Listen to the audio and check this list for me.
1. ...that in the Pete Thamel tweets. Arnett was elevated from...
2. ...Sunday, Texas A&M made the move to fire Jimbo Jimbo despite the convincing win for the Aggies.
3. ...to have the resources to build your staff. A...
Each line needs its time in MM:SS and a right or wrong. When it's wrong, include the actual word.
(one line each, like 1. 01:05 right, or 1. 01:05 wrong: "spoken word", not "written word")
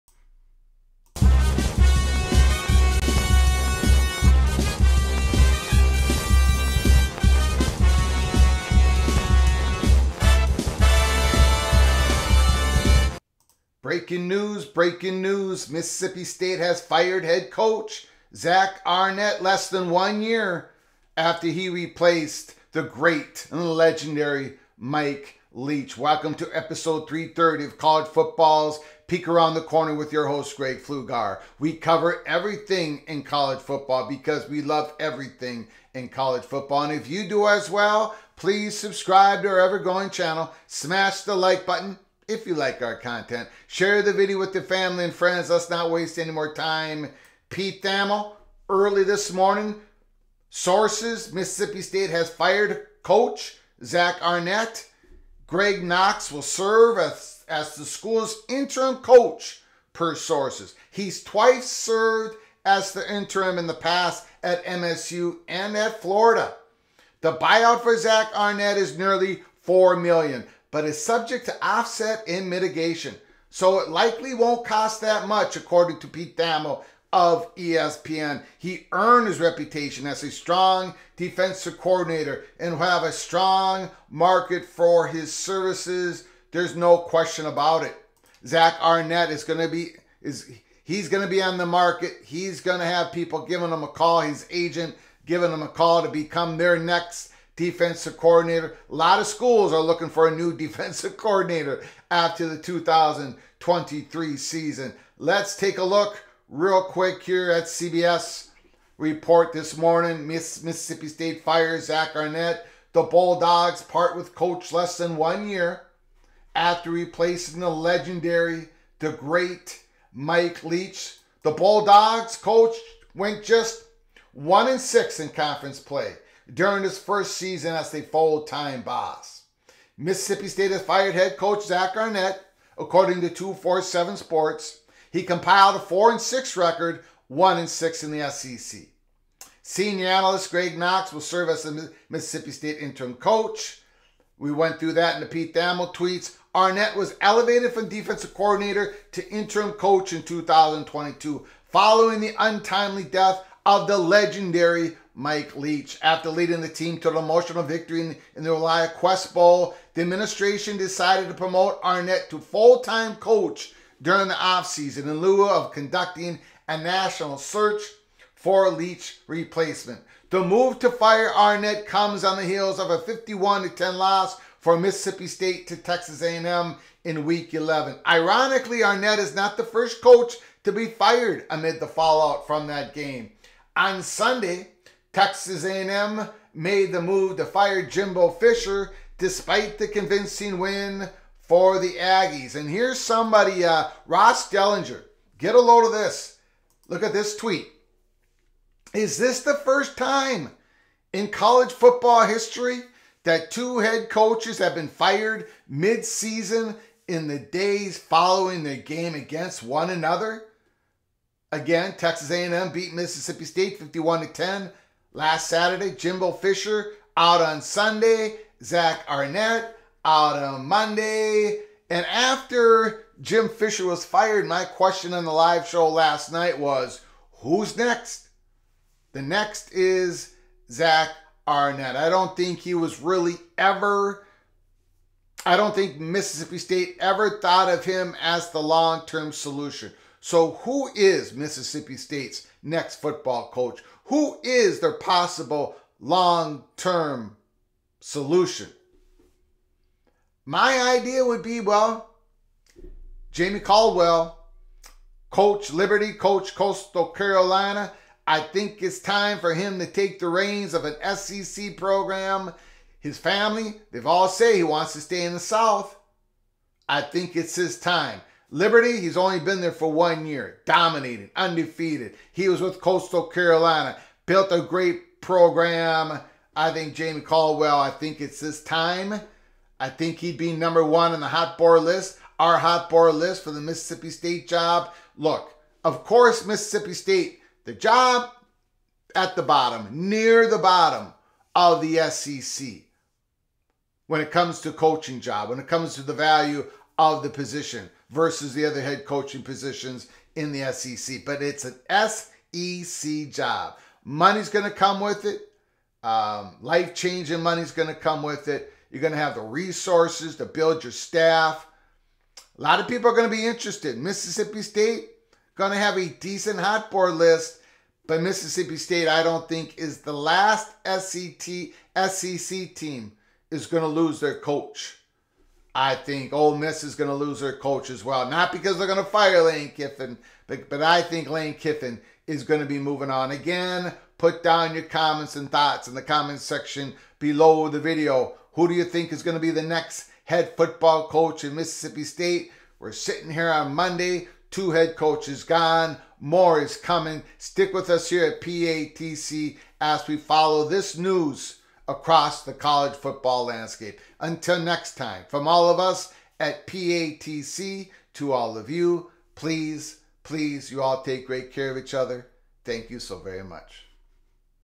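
1. 02:24 right
2. 03:04 wrong: "Fisher", not "Jimbo"
3. 05:09 right.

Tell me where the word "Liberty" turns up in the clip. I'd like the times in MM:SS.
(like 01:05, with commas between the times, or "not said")
04:15, 04:28.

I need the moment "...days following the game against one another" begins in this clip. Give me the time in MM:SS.
03:27.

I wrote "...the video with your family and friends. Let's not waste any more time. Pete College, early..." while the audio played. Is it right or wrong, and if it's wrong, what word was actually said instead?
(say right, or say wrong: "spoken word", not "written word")
wrong: "Thamel", not "College".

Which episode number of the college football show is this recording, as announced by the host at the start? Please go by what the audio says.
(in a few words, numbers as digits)
330.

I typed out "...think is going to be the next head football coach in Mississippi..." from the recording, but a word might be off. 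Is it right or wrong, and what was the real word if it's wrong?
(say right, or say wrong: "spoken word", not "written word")
right.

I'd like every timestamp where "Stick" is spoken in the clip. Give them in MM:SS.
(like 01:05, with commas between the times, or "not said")
05:47.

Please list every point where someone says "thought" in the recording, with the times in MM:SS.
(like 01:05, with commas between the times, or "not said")
03:57, 05:35.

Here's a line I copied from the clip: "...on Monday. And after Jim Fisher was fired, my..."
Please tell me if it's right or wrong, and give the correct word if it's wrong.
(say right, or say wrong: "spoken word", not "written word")
right.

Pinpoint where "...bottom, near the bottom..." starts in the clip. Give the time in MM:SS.
04:49.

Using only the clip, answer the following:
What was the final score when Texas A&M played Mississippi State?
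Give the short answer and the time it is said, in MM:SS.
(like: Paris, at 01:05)
51-10, at 02:52.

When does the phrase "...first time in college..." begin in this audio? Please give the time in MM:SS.
03:19.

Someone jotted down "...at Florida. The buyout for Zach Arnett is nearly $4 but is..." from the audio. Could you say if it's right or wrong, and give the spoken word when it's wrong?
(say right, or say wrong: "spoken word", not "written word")
right.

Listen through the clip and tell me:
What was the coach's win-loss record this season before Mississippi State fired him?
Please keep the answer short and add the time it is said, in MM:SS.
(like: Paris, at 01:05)
4 and 6, at 02:15.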